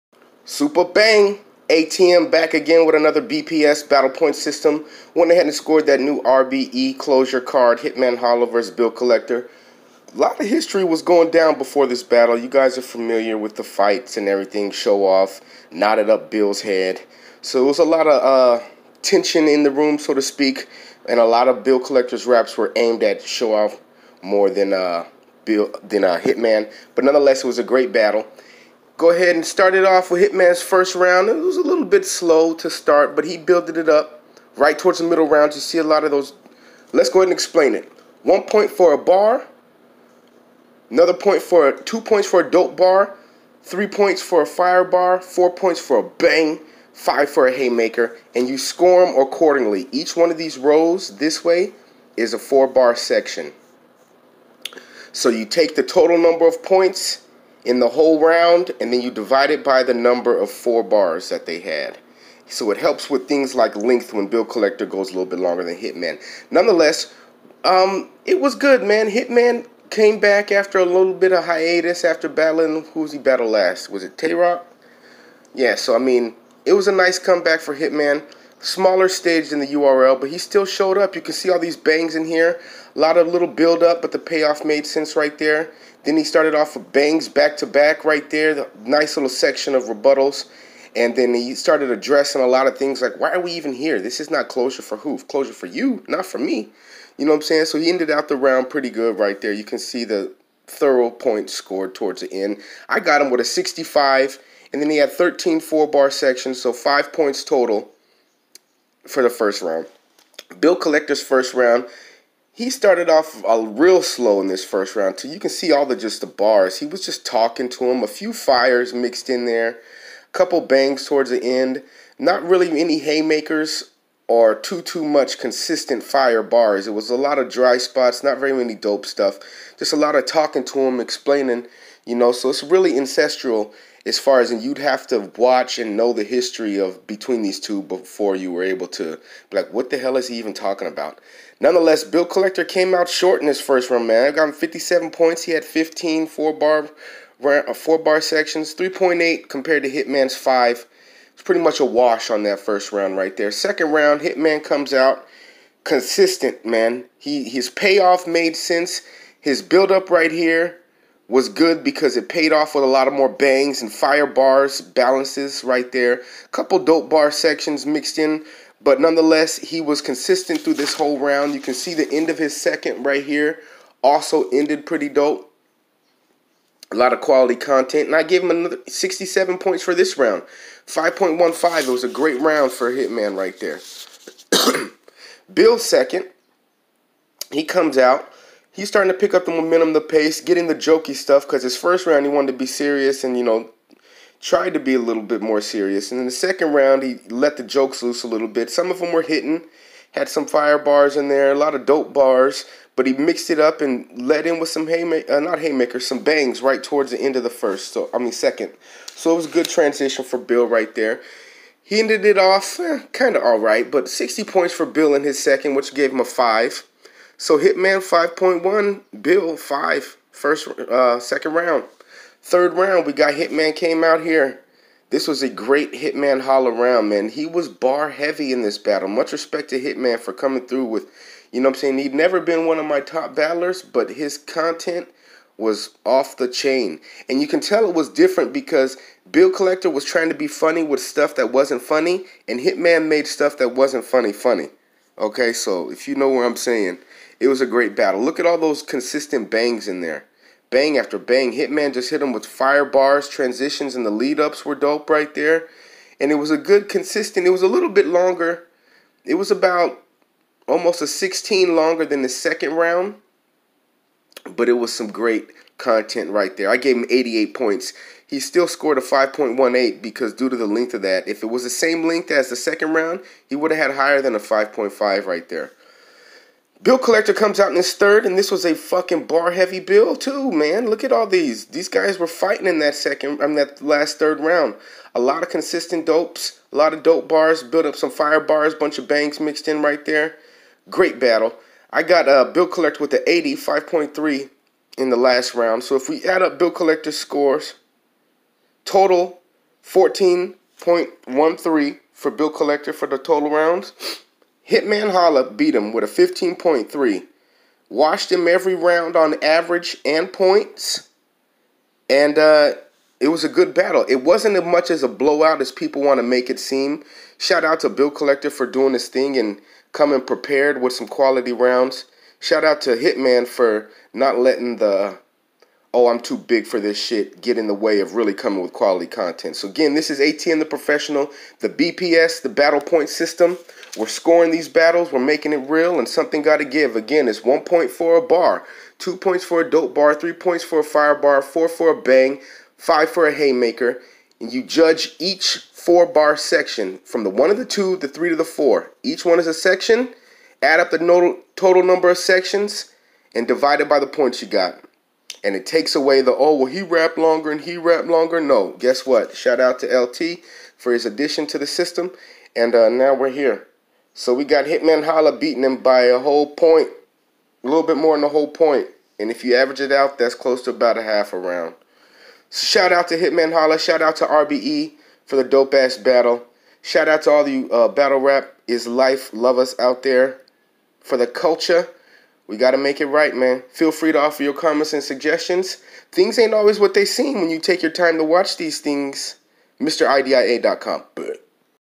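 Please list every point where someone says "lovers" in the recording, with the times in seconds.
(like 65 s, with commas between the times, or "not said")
379 s.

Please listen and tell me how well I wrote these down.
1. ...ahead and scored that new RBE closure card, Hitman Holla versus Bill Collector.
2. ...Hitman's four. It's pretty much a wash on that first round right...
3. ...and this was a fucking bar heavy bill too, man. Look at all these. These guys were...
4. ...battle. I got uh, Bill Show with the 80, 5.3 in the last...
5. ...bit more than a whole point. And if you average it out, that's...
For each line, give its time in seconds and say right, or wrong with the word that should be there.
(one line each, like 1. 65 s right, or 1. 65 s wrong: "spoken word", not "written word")
1. 5 s right
2. 149 s wrong: "five", not "four"
3. 278 s right
4. 291 s wrong: "Collector", not "Show"
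5. 367 s right.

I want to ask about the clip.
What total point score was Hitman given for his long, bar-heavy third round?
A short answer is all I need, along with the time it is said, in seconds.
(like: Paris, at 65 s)
88, at 267 s.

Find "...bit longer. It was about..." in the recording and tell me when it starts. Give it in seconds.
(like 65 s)
257 s.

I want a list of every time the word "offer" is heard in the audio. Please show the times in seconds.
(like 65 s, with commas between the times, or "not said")
384 s.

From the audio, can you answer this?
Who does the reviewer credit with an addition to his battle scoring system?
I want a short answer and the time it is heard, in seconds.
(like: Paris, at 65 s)
LT, at 359 s.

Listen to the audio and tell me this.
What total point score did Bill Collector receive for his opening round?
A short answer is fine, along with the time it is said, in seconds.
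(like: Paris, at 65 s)
57, at 144 s.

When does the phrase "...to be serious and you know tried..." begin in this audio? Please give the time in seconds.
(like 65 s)
192 s.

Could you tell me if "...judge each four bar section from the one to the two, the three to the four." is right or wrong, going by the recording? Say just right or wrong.
right.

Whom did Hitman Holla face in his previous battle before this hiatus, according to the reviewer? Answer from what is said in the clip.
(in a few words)
Tay Roc.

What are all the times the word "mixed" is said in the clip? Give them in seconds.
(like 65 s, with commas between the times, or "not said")
118 s, 167 s, 203 s, 289 s.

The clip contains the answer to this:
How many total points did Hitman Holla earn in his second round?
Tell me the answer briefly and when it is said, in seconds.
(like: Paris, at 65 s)
67, at 178 s.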